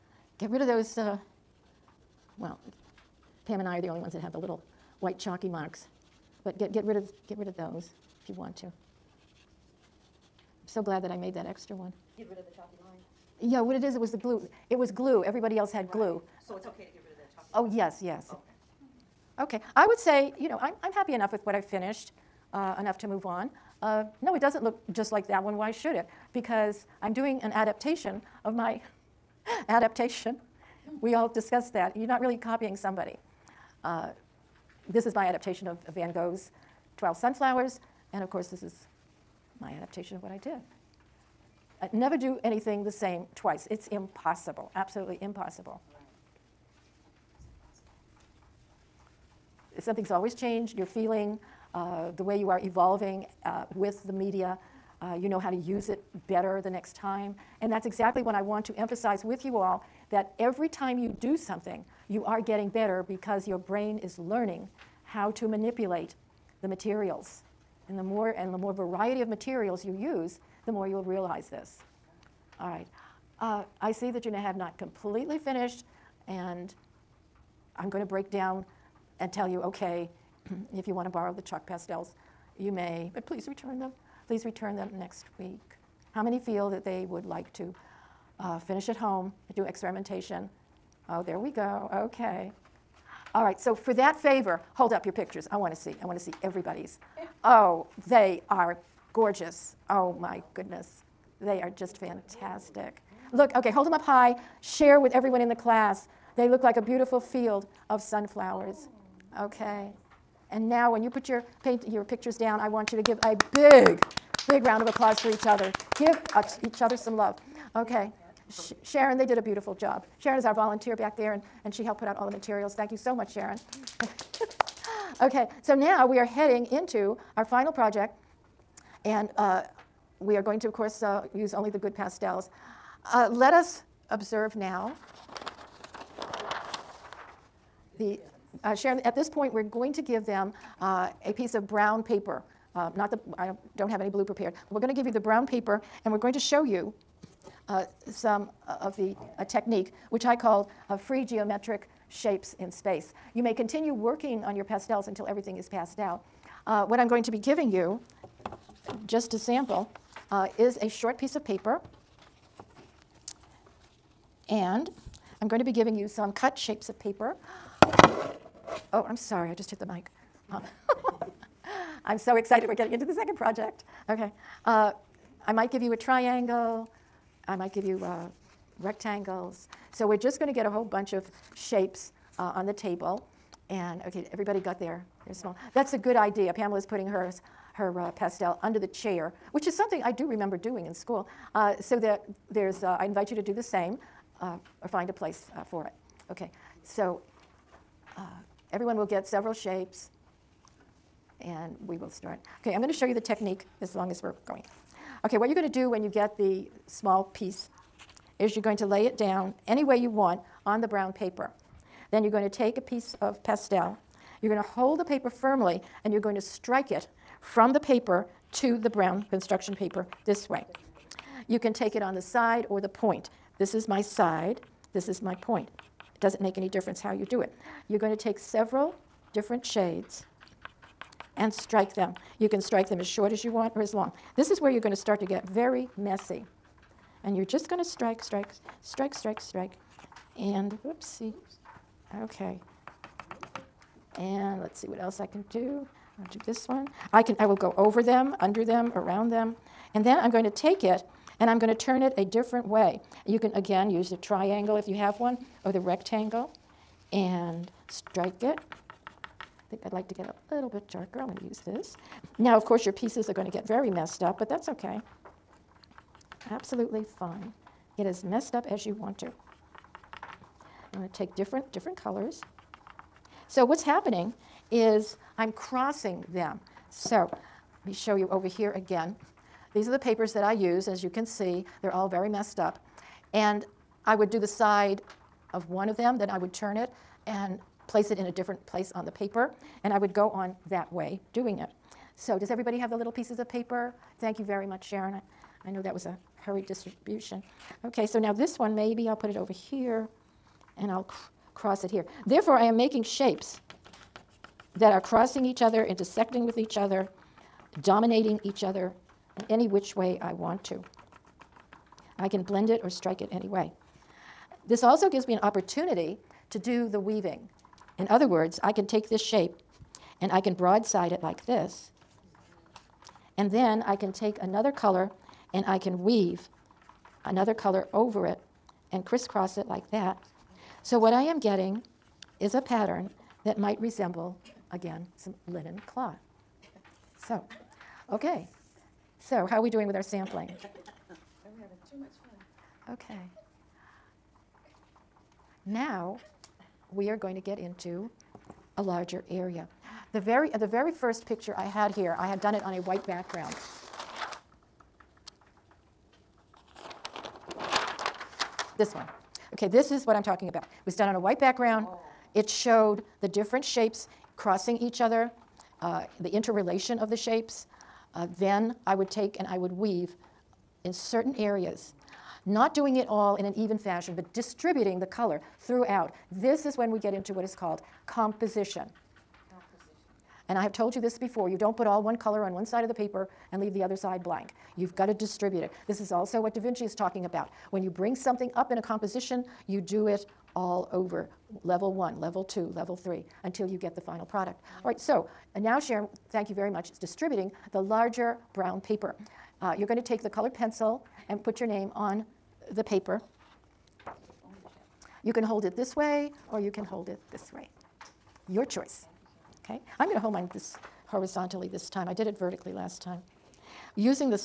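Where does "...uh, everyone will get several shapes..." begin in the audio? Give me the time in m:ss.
3:18.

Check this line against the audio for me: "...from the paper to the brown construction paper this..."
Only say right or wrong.
right.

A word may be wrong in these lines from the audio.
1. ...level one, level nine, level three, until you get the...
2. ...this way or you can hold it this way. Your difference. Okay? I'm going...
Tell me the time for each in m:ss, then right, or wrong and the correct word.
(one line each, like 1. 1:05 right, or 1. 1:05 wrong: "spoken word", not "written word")
1. 6:31 wrong: "two", not "nine"
2. 6:45 wrong: "choice", not "difference".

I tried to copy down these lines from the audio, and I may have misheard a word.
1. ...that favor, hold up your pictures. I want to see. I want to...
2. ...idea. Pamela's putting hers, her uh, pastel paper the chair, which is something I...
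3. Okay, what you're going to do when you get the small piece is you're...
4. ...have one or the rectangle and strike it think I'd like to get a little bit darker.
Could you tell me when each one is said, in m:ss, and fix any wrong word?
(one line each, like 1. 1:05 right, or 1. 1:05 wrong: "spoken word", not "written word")
1. 1:33 right
2. 3:06 wrong: "under", not "paper"
3. 3:25 right
4. 4:14 right.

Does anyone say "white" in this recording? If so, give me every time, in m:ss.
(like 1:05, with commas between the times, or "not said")
0:05, 5:52, 6:01.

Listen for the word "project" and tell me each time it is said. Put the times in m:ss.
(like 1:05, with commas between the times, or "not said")
2:07, 2:53.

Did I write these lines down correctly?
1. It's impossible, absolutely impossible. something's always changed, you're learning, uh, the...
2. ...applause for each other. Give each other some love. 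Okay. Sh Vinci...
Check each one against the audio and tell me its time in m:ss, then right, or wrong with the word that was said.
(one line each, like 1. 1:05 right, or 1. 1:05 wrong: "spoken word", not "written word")
1. 0:43 wrong: "feeling", not "learning"
2. 1:54 wrong: "Sharon", not "Vinci".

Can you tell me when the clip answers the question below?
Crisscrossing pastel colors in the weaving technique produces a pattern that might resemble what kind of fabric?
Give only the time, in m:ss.
5:35.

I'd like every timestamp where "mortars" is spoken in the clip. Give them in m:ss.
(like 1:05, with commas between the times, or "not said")
not said.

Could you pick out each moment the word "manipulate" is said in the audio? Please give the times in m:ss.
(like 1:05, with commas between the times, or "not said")
1:05.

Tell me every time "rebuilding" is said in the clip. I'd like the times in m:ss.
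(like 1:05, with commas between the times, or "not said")
not said.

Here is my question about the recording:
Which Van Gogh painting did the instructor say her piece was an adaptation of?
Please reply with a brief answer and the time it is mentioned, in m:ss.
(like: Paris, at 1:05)
12 Sunflowers, at 0:36.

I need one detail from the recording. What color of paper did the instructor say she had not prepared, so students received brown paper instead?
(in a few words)
Blue.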